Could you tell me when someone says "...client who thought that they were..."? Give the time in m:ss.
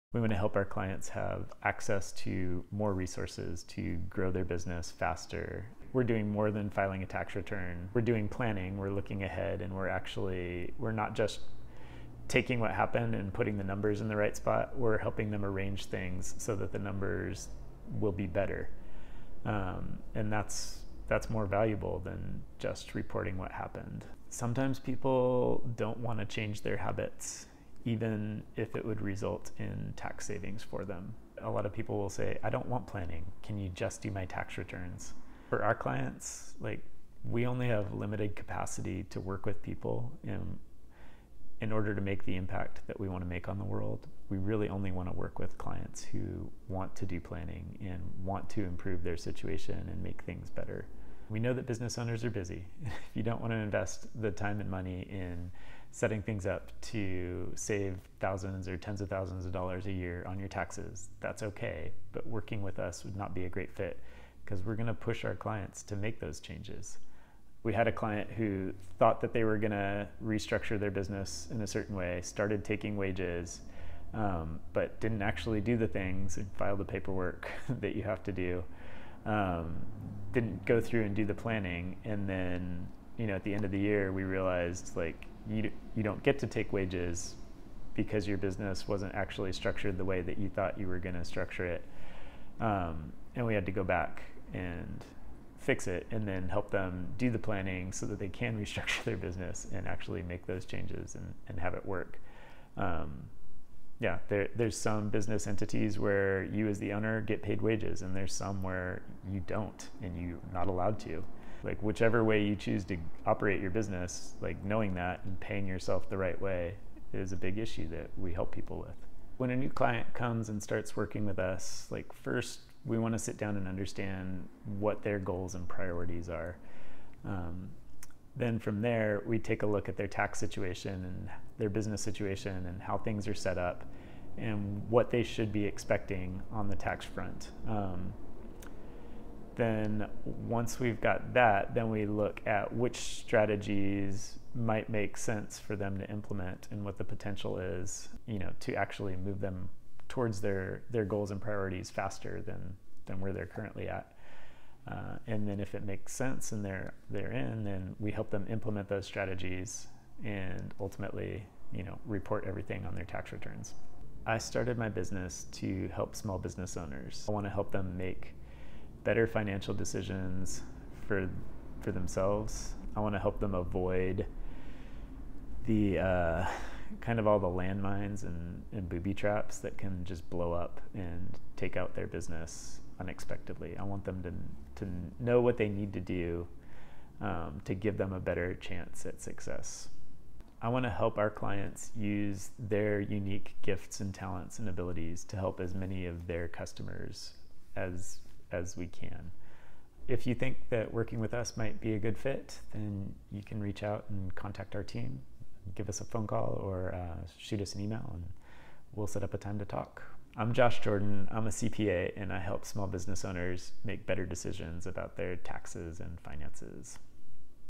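1:07.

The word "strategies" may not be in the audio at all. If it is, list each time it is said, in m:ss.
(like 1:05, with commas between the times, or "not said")
2:22, 2:39.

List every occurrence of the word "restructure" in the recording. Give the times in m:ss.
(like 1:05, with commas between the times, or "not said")
1:10, 1:38.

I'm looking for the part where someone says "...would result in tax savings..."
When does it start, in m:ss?
0:28.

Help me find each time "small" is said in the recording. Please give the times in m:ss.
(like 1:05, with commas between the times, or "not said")
2:46, 3:32.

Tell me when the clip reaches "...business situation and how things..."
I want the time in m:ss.
2:11.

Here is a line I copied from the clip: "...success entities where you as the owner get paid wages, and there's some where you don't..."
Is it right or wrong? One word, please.
wrong.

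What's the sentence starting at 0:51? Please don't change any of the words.
We know that business owners are busy.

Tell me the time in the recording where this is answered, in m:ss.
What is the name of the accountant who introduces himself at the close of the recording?
3:30.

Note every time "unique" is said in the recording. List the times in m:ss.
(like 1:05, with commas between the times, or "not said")
3:12.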